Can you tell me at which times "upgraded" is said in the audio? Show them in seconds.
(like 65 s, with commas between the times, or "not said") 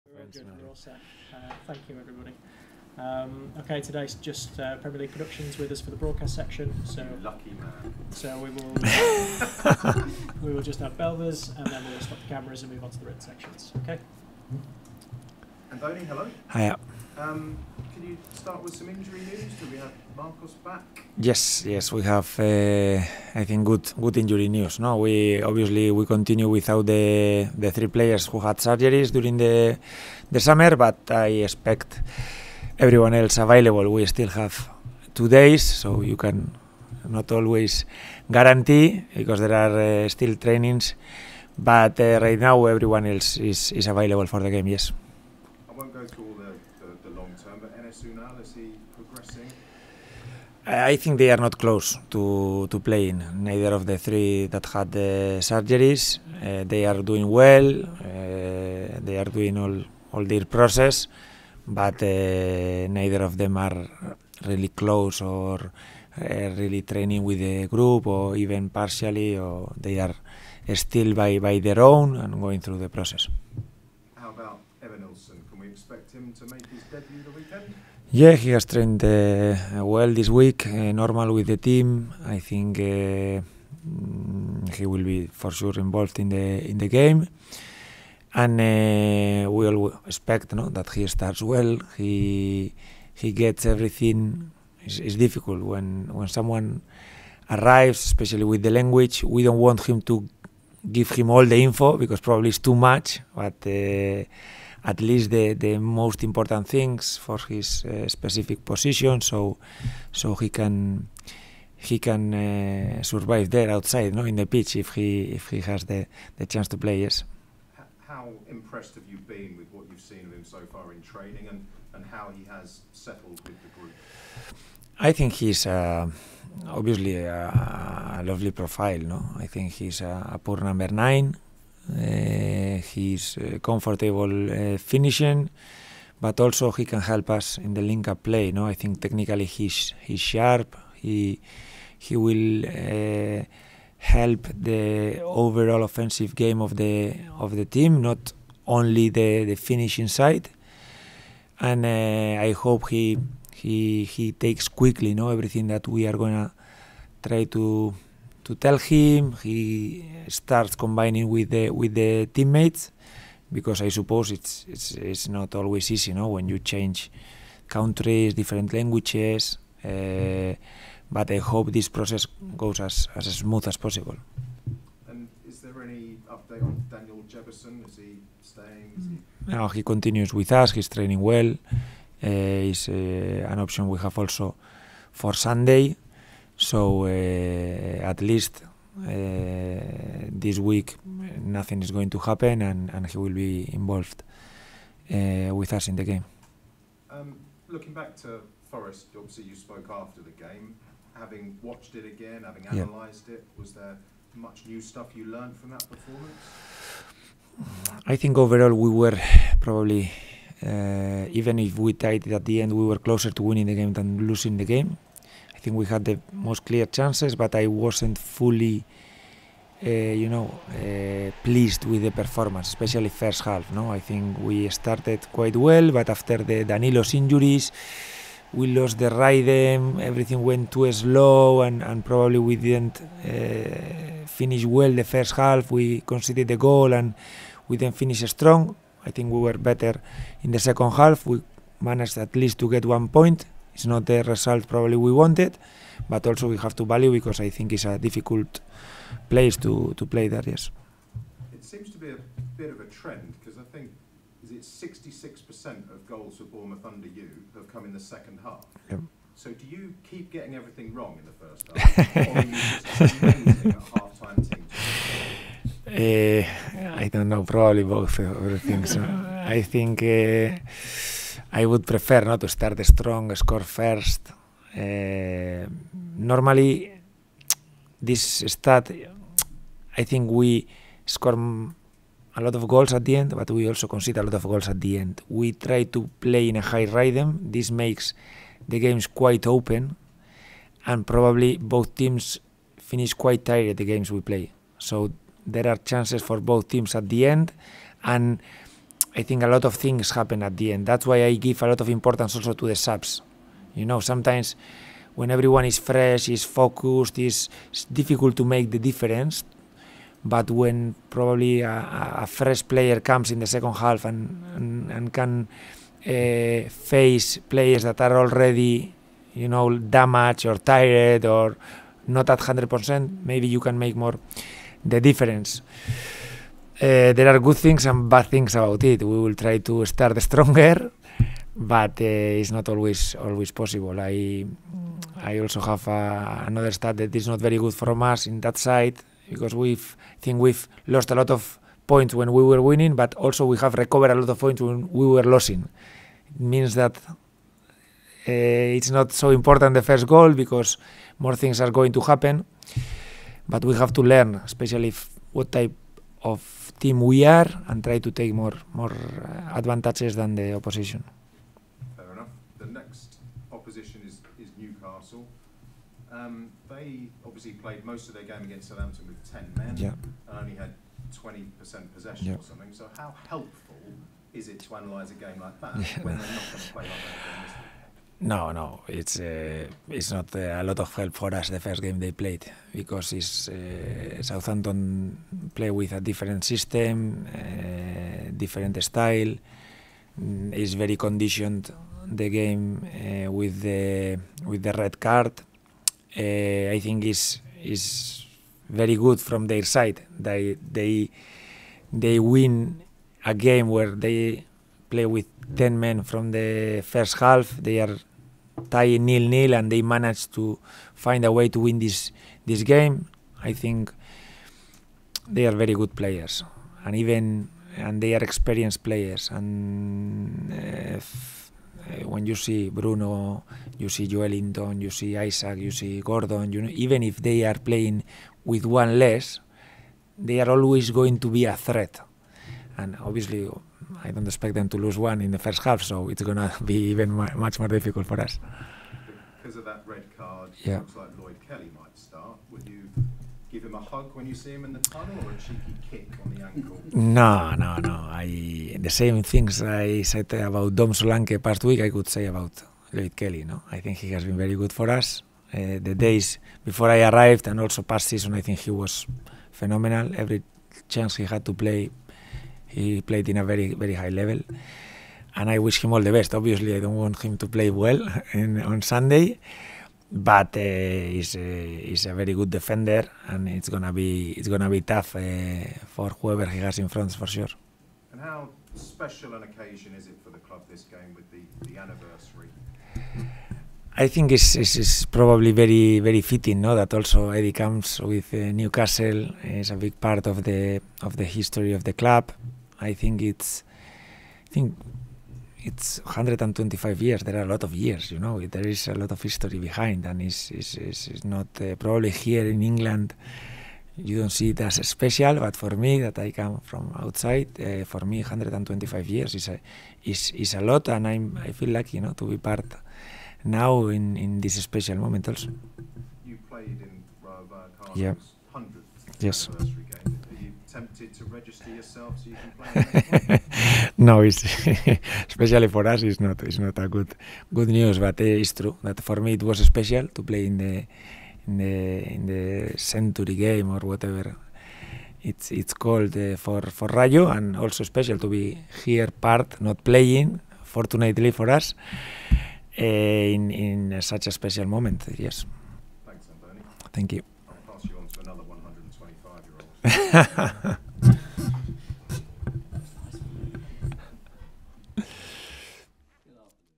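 not said.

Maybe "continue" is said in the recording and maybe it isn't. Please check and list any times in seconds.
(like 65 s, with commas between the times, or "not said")
26 s, 179 s.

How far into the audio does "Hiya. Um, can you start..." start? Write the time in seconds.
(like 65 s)
16 s.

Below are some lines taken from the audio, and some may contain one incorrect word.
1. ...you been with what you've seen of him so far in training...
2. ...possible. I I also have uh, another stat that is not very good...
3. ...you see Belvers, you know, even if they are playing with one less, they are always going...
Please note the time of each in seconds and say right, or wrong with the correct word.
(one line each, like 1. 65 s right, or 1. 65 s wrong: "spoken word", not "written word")
1. 119 s right
2. 333 s right
3. 425 s wrong: "Gordon", not "Belvers".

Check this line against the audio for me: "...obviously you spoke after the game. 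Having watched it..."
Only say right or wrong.
right.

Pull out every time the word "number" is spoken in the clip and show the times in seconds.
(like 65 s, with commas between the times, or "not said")
130 s.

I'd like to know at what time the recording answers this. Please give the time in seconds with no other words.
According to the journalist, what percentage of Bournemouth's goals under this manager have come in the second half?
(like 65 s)
254 s.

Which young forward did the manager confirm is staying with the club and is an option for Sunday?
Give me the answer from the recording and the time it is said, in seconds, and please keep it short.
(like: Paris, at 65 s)
Daniel Jebbison, at 176 s.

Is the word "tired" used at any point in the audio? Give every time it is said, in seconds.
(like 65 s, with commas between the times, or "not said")
293 s, 320 s.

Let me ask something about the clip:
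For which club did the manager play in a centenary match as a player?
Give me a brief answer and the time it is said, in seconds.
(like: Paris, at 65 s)
Rayo, at 536 s.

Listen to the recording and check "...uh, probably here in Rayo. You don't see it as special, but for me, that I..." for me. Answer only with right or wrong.
wrong.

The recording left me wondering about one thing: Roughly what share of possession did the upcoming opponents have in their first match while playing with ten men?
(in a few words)
20%.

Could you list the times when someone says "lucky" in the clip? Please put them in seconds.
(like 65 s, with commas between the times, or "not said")
7 s, 511 s.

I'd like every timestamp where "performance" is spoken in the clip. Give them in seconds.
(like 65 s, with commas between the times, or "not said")
205 s, 222 s.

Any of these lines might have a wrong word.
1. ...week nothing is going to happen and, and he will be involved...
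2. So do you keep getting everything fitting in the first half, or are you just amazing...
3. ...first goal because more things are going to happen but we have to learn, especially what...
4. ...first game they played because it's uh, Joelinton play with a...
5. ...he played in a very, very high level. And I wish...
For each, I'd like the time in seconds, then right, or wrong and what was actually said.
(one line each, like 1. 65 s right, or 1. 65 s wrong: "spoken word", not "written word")
1. 190 s right
2. 259 s wrong: "wrong", not "fitting"
3. 349 s right
4. 381 s wrong: "Southampton", not "Joelinton"
5. 462 s right.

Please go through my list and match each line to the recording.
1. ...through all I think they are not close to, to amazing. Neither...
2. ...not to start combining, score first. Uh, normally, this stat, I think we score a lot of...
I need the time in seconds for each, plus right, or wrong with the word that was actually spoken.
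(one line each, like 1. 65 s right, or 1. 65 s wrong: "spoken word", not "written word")
1. 46 s wrong: "playing", not "amazing"
2. 272 s wrong: "strong", not "combining".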